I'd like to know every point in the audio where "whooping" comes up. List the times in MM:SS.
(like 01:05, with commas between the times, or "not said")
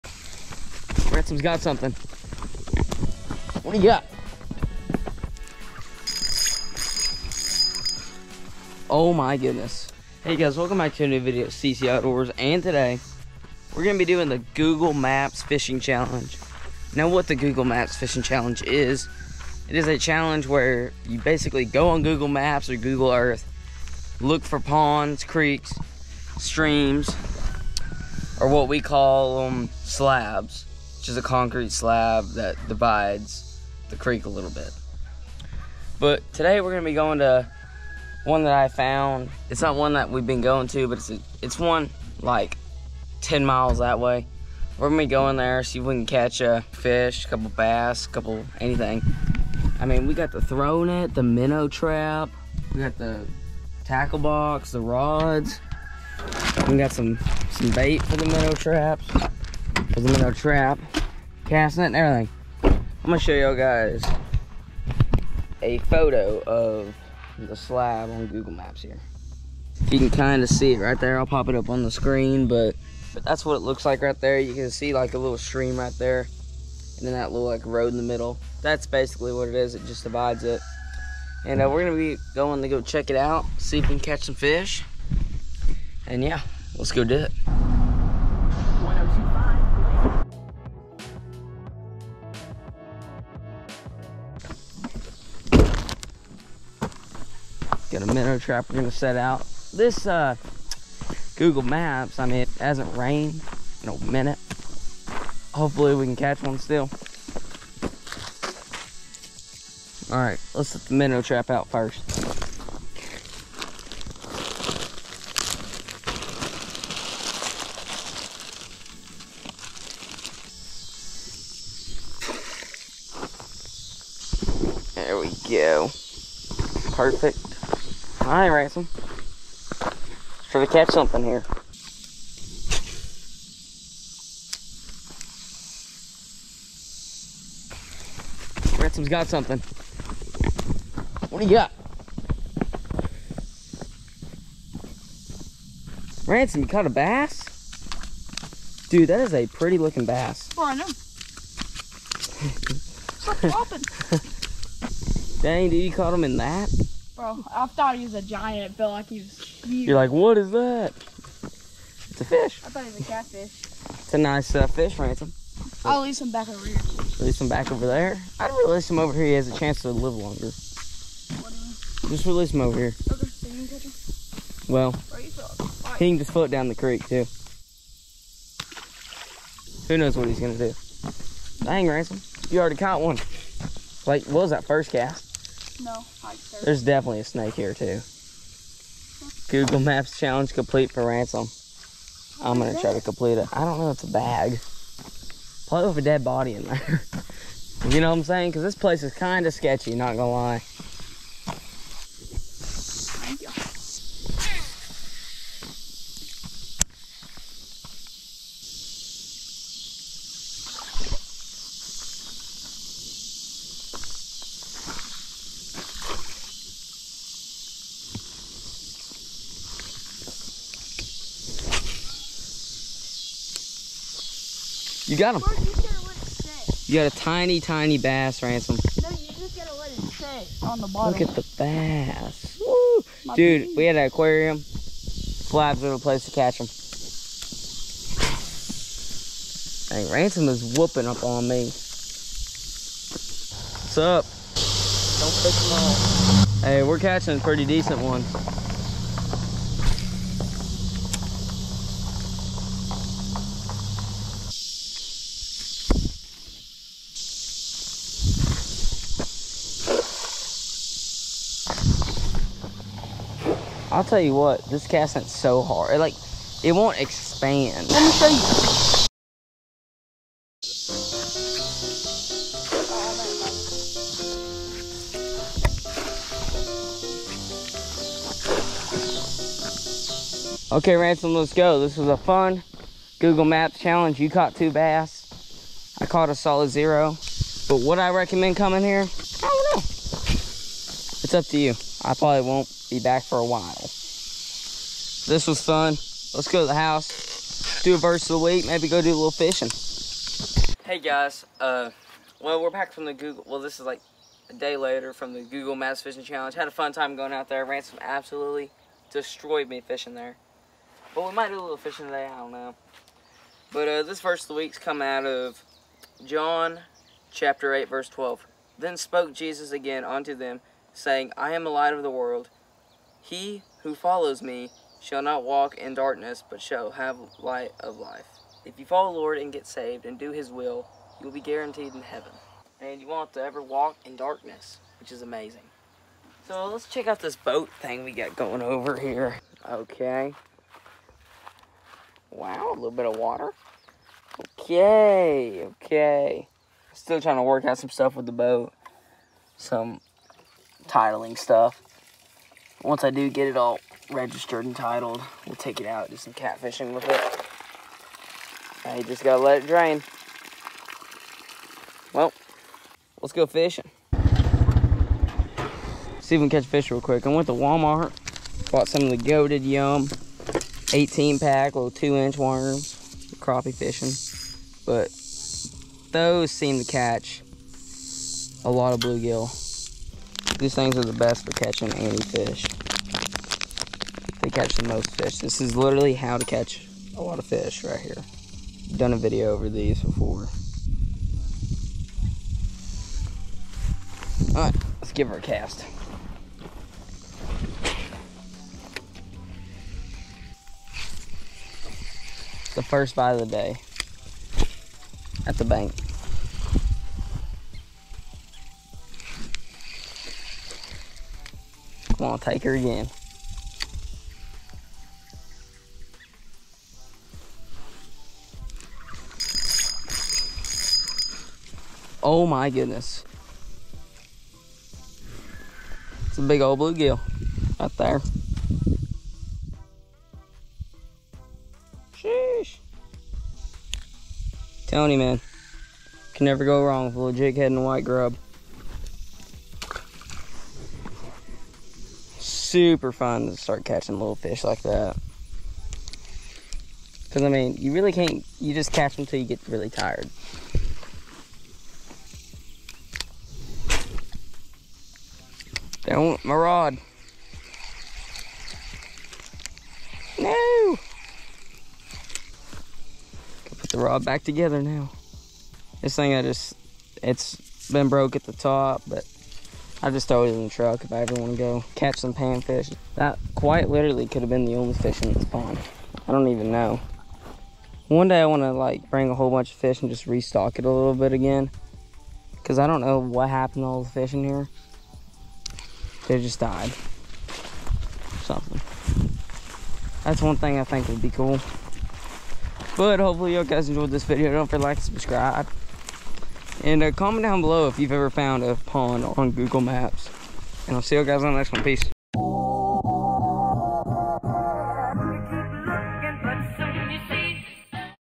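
04:00.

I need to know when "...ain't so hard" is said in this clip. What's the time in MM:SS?
04:24.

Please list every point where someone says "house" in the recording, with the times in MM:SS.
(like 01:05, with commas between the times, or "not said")
04:56.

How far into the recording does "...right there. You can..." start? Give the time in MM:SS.
01:14.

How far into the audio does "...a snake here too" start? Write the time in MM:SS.
03:07.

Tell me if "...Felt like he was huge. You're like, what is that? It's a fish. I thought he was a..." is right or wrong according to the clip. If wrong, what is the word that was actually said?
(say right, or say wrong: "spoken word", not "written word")
right.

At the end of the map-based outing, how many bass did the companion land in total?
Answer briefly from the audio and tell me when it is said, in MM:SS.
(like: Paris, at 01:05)
2, at 04:44.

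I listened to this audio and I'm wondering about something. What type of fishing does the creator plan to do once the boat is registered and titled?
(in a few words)
Catfishing.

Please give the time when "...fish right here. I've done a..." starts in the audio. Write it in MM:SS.
06:27.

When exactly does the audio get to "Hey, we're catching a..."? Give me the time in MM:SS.
04:06.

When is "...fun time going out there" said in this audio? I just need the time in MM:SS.
05:06.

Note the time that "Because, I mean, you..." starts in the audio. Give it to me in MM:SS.
07:27.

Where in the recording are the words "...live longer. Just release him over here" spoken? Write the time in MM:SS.
02:49.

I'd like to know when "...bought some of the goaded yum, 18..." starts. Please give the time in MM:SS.
06:08.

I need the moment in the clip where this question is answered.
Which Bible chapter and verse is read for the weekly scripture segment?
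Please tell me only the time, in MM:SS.
05:16.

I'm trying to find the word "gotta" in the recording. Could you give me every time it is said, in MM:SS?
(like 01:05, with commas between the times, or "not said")
03:49, 05:59.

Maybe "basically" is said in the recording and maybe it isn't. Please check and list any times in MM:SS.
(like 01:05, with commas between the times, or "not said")
00:21, 01:18.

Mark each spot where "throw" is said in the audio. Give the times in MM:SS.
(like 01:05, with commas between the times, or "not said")
00:50, 07:50.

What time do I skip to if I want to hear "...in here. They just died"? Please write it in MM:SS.
08:04.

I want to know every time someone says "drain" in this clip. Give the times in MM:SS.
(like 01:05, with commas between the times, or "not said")
05:59.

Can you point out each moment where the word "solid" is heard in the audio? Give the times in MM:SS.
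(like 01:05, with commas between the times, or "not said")
04:46.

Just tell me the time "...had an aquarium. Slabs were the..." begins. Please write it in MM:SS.
03:53.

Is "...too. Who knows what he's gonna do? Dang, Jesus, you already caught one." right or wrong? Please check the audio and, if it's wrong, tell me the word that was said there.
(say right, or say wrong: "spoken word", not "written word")
wrong: "Ransom", not "Jesus".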